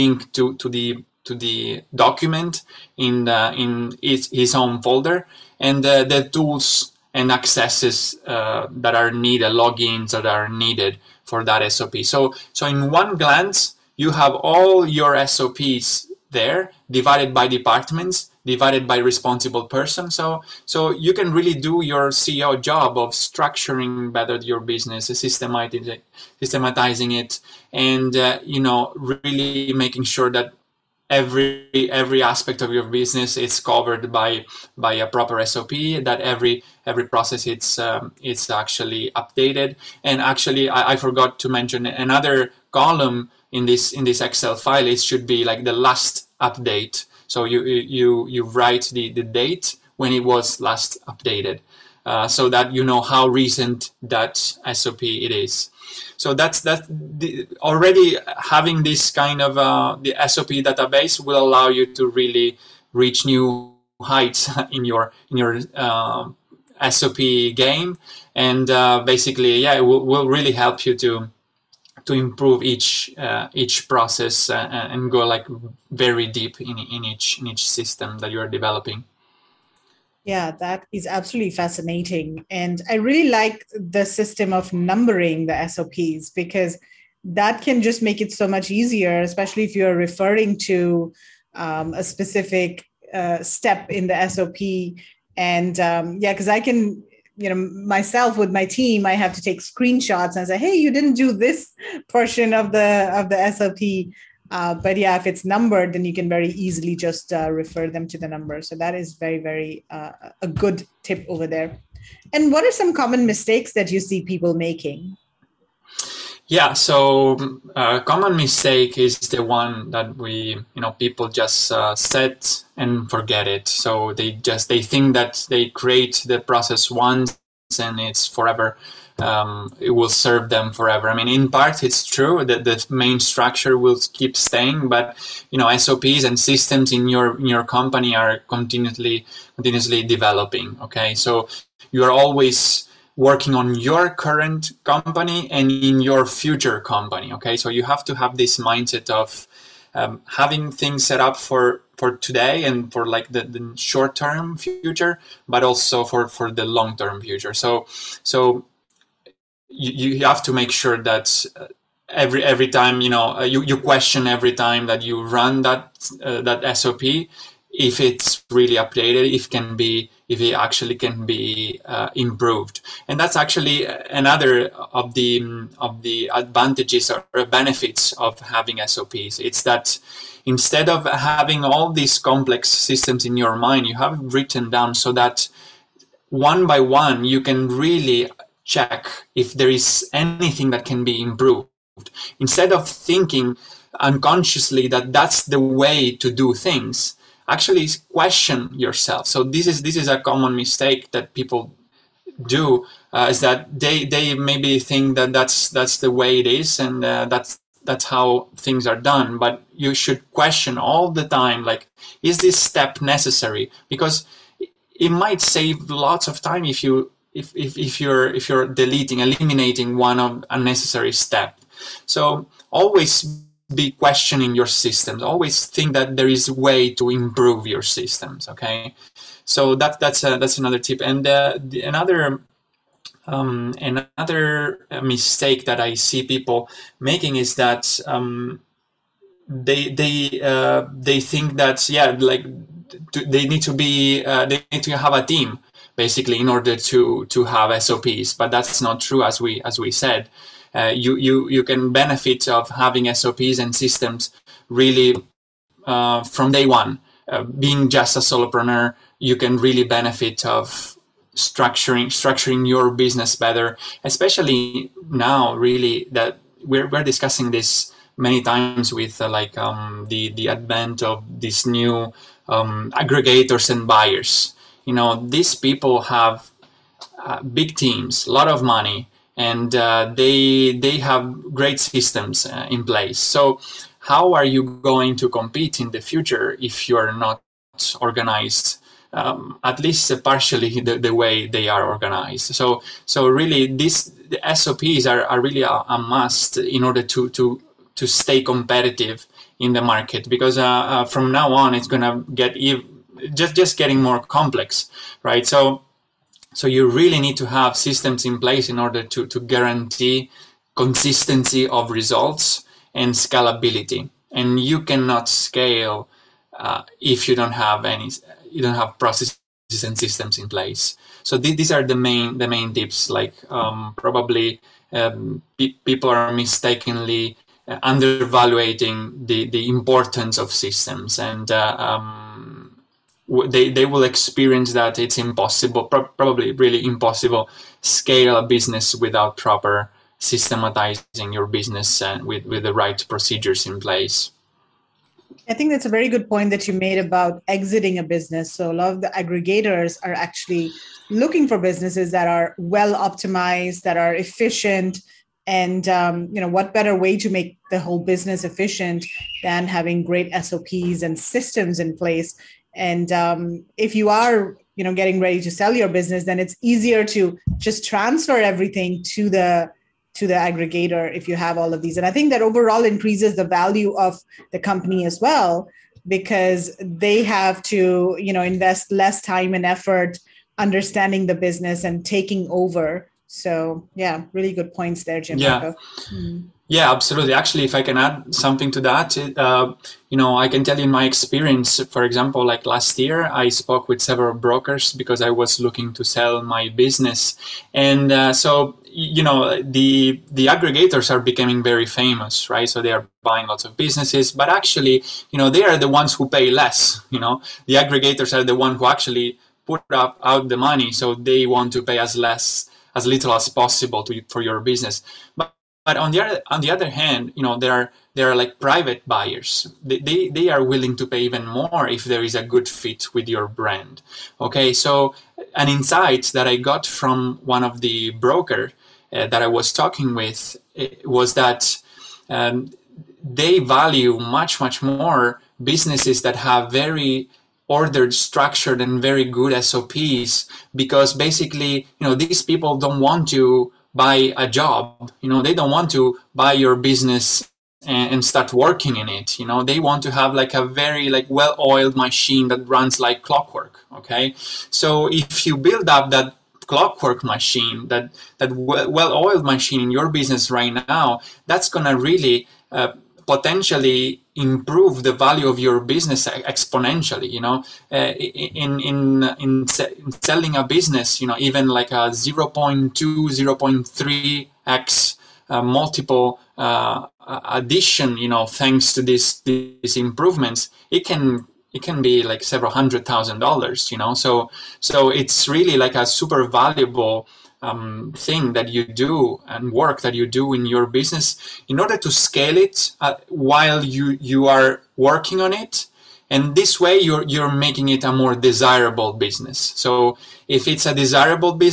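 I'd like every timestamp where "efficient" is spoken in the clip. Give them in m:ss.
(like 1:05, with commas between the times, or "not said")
5:54, 5:58.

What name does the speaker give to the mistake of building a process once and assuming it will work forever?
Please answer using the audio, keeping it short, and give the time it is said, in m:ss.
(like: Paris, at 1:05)
set and forget, at 2:01.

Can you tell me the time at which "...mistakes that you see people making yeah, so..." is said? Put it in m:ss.
1:53.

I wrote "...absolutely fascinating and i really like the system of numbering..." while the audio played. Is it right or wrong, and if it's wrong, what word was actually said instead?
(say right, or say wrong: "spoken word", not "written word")
right.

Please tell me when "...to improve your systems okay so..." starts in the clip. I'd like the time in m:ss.
3:46.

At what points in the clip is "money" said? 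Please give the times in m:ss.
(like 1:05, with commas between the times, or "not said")
4:38, 6:50.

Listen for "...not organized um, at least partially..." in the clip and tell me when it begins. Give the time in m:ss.
4:47.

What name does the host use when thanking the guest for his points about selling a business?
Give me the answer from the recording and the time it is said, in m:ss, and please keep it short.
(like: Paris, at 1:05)
Jim, at 6:25.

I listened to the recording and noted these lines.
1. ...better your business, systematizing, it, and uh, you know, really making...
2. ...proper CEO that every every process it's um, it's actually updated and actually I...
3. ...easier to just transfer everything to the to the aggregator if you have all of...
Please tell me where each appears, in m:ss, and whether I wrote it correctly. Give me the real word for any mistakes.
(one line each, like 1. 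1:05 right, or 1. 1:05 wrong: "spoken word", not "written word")
1. 0:24 right
2. 0:35 wrong: "SOP", not "CEO"
3. 6:06 right.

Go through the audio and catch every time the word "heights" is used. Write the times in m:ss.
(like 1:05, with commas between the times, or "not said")
1:04.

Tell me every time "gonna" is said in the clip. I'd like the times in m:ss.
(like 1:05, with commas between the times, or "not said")
5:01, 7:41.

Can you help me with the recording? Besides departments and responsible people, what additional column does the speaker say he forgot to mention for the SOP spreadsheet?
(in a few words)
last update.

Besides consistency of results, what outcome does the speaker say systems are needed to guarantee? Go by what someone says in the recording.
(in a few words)
scalability.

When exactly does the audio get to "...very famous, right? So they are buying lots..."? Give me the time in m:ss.
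6:41.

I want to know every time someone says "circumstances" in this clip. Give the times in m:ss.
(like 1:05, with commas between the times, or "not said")
not said.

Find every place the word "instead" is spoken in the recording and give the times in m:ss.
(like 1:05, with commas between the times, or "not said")
3:00, 3:12.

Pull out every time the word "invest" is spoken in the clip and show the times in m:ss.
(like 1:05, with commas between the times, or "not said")
6:18.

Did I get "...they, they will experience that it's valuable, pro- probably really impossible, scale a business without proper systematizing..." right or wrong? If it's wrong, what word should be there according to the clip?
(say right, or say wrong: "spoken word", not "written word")
wrong: "impossible", not "valuable".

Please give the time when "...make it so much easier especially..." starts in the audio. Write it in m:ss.
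1:28.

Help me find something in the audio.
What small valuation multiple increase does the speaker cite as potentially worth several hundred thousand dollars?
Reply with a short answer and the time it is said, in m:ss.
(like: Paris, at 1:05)
0.2 to 0.3x, at 7:52.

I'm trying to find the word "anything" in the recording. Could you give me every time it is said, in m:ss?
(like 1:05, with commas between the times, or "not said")
3:10.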